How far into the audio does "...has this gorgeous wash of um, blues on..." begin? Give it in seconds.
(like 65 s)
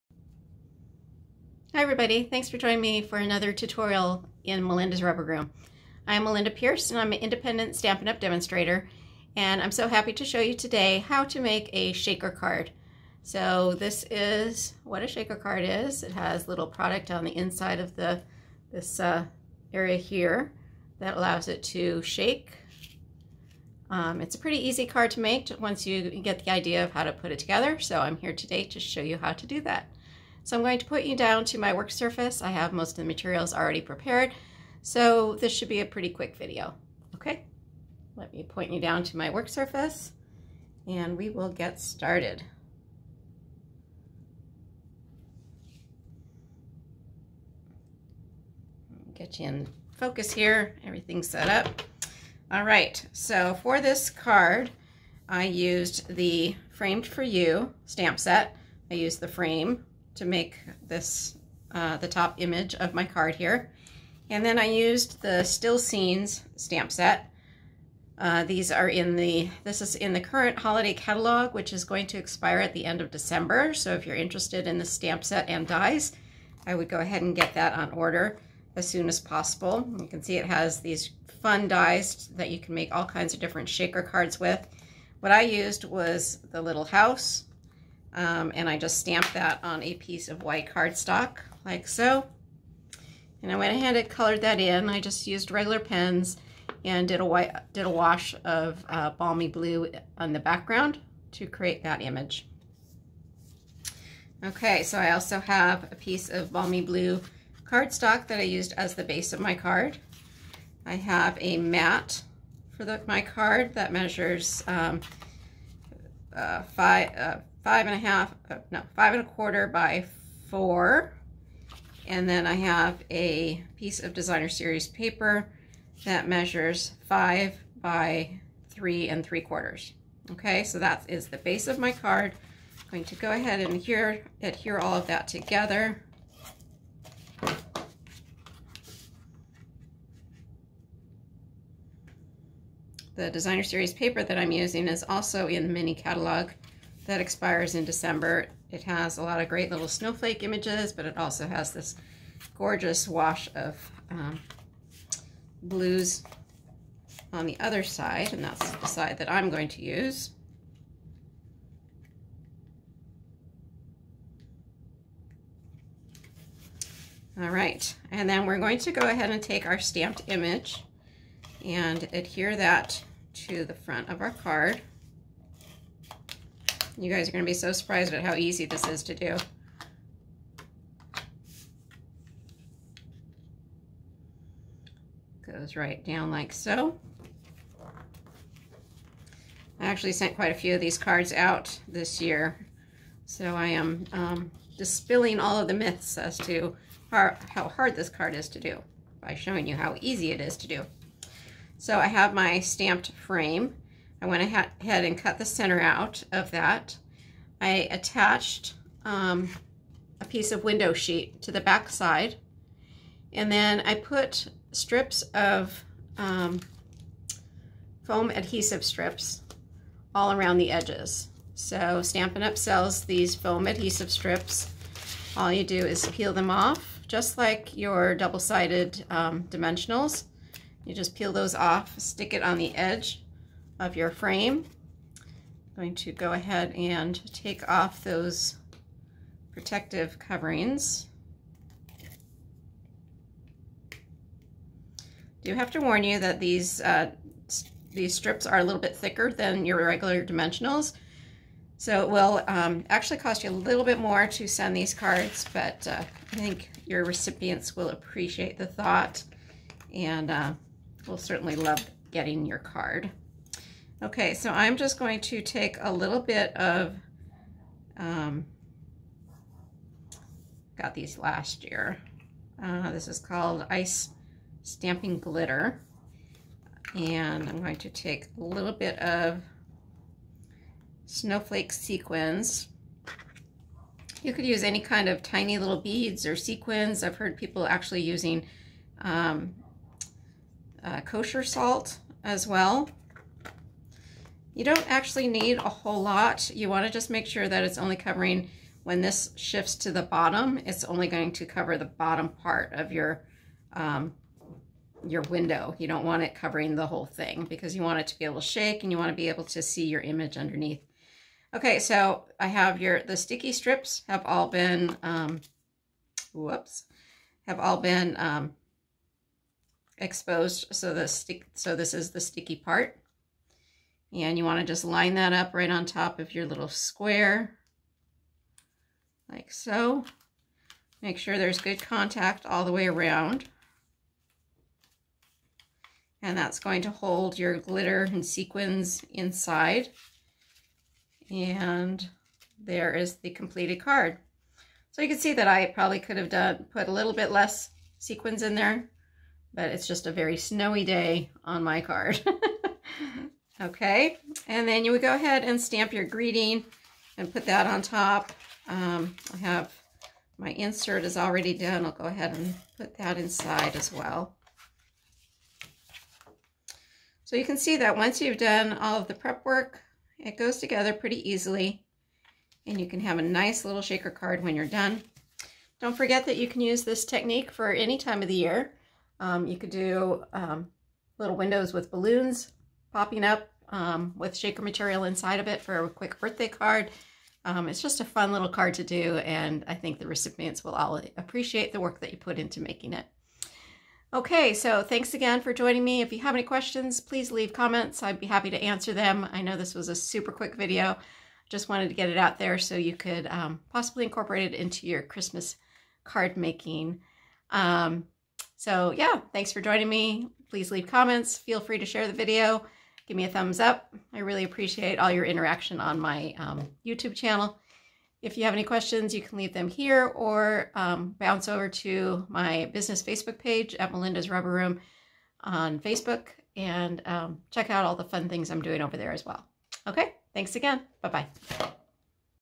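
151 s.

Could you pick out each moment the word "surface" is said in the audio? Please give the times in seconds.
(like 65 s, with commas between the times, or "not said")
31 s, 39 s.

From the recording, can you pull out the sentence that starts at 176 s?
You guys are going to be so surprised at how easy this is to do.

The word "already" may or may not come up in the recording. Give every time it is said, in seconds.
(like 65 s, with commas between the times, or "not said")
33 s, 361 s.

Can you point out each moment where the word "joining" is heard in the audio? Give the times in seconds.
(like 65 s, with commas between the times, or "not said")
2 s, 395 s, 409 s.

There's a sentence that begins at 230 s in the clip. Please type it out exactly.
You just peel those off, stick it on the edge of your frame.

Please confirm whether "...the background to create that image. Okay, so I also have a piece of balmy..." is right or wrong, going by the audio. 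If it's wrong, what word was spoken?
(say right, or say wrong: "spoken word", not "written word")
right.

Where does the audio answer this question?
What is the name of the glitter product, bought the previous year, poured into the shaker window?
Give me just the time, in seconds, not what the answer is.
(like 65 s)
273 s.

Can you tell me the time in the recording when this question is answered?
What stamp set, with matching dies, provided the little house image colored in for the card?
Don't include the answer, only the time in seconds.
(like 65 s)
65 s.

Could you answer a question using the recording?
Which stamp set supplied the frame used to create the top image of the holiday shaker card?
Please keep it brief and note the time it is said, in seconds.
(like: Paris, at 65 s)
Framed For You, at 56 s.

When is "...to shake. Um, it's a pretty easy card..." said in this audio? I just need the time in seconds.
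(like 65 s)
21 s.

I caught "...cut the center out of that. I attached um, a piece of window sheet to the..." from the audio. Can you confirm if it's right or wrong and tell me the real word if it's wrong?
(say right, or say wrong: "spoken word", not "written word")
right.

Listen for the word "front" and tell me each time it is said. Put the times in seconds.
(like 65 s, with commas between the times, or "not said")
173 s.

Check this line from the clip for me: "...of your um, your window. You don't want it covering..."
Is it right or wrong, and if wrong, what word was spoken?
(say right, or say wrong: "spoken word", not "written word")
right.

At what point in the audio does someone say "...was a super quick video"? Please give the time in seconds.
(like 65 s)
399 s.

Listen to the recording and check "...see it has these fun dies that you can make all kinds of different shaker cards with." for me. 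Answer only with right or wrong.
right.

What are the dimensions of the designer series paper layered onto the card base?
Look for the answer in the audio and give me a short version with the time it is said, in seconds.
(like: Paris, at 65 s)
5 by 3 3/4, at 127 s.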